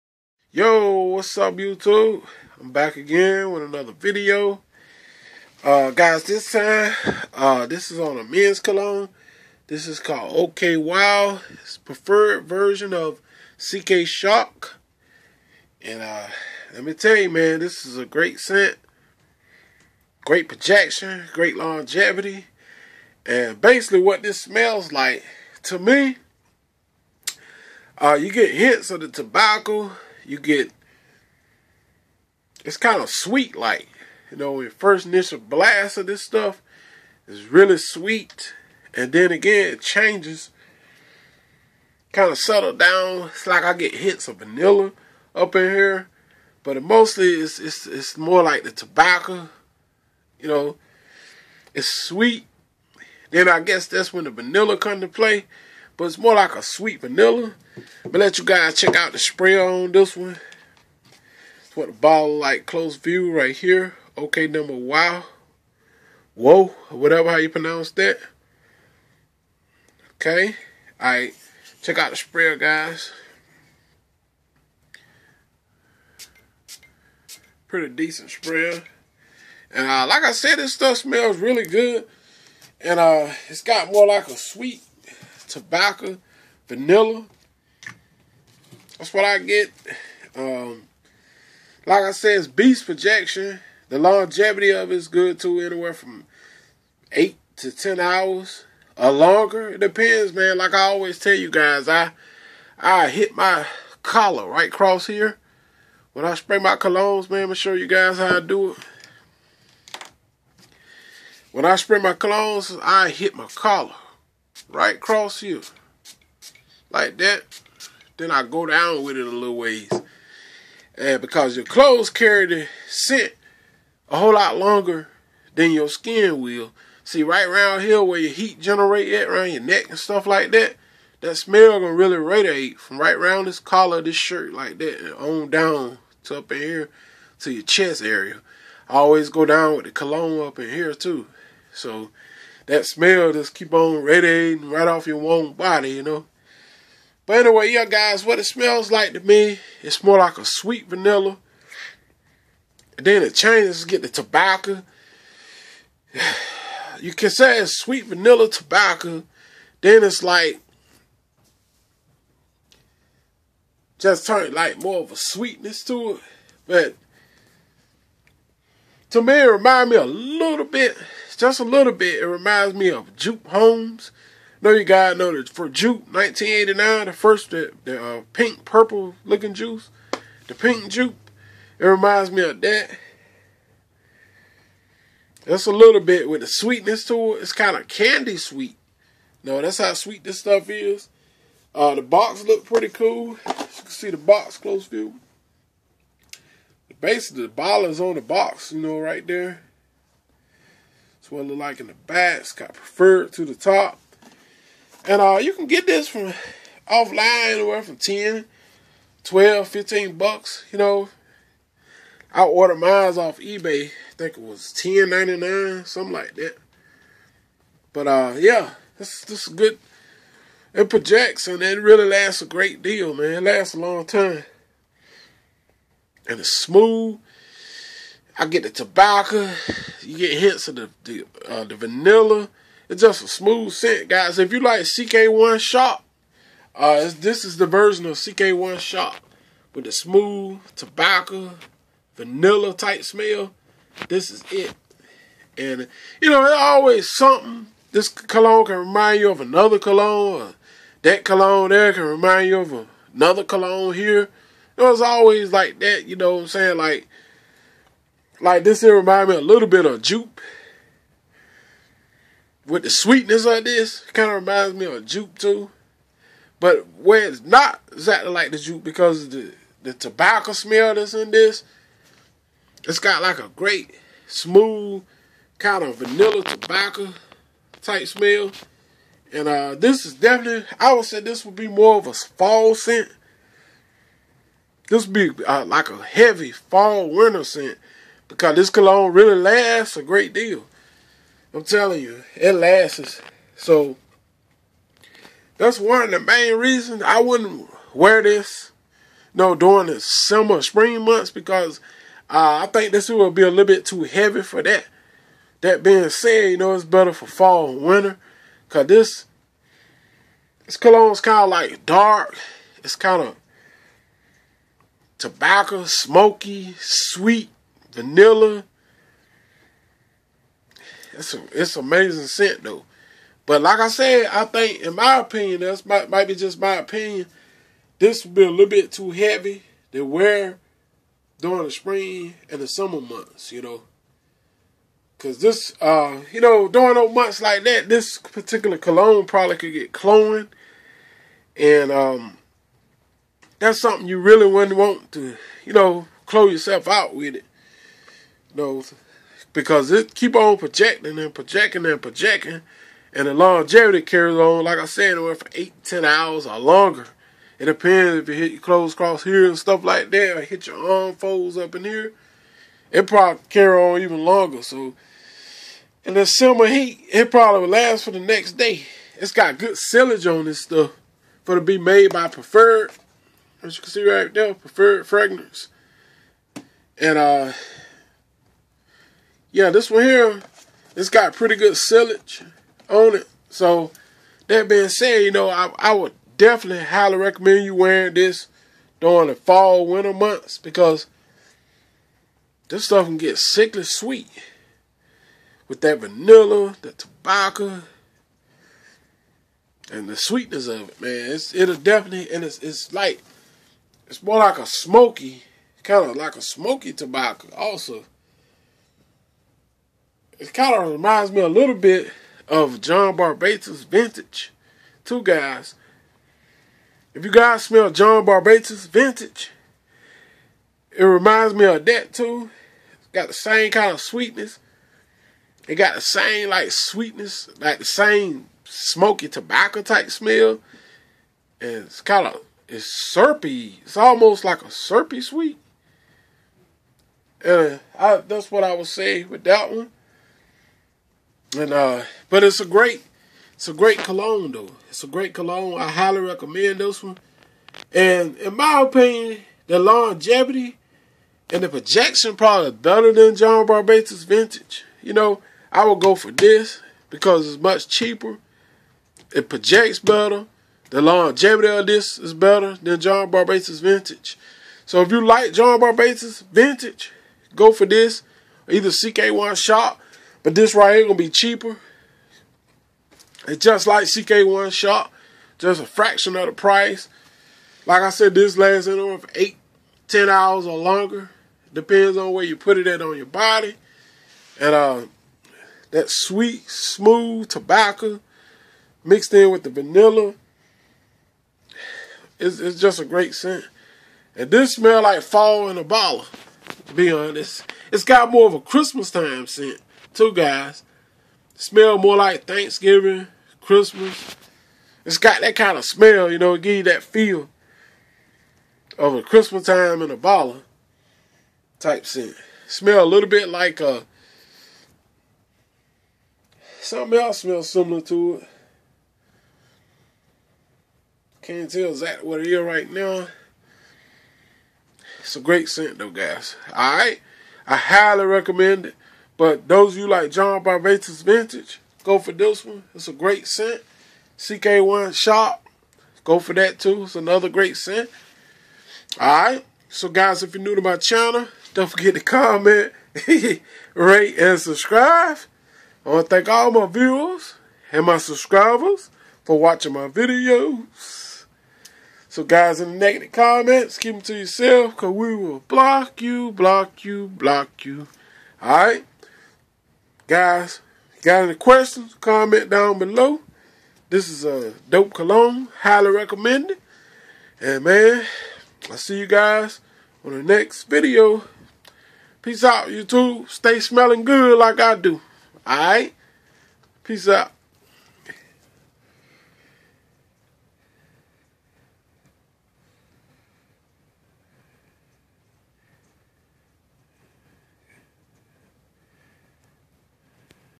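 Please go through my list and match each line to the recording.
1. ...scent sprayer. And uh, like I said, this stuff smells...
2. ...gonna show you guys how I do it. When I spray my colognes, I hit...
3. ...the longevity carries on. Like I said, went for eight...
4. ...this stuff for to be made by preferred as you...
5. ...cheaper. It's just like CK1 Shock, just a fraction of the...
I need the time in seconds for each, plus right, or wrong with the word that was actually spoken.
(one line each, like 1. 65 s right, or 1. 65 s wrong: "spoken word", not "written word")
1. 77 s wrong: "decent", not "scent"
2. 107 s right
3. 353 s right
4. 370 s right
5. 471 s right.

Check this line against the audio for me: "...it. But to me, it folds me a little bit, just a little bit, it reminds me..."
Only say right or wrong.
wrong.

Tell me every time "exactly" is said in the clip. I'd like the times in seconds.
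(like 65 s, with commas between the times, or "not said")
267 s, 521 s.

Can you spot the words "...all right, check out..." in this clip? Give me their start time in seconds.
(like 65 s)
70 s.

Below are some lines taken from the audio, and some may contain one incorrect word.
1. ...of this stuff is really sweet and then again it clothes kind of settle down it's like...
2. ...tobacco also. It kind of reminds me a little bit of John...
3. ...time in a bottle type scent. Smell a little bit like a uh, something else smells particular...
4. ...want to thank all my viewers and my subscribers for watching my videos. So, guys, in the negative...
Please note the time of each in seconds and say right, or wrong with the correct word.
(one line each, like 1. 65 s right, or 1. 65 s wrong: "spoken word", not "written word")
1. 35 s wrong: "changes", not "clothes"
2. 406 s right
3. 509 s wrong: "similar", not "particular"
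4. 546 s right.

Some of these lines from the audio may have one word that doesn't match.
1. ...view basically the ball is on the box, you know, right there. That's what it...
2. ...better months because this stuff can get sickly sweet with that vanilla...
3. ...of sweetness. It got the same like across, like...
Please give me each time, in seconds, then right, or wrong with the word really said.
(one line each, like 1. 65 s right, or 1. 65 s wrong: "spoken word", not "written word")
1. 194 s right
2. 389 s wrong: "winter", not "better"
3. 423 s wrong: "sweetness", not "across".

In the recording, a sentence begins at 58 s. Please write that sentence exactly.
But let you guys check out the spray on this one.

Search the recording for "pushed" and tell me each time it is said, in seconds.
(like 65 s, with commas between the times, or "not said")
not said.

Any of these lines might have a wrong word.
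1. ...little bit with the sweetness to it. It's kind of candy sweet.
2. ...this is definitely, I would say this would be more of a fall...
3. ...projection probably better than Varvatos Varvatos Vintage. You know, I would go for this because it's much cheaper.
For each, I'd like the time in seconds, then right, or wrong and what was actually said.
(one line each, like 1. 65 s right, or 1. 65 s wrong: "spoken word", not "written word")
1. 185 s right
2. 279 s right
3. 451 s wrong: "John", not "Varvatos".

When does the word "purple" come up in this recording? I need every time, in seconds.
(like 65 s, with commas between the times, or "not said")
178 s.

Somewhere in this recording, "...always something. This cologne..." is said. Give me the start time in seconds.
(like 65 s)
246 s.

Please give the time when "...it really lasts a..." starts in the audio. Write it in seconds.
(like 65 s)
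221 s.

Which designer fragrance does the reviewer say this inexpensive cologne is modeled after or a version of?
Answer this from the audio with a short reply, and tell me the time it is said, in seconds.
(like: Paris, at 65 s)
CK Shock, at 13 s.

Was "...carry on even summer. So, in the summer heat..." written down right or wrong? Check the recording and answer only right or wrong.
wrong.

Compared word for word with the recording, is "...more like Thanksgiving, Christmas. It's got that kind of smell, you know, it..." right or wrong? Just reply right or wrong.
right.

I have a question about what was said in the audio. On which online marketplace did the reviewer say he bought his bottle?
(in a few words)
eBay.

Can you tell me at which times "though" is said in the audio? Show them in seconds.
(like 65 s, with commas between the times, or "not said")
322 s, 444 s, 525 s.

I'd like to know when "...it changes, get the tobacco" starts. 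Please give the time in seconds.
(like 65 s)
153 s.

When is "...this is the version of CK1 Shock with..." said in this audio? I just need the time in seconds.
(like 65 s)
237 s.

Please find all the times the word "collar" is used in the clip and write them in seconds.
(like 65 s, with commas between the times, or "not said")
104 s, 113 s, 133 s.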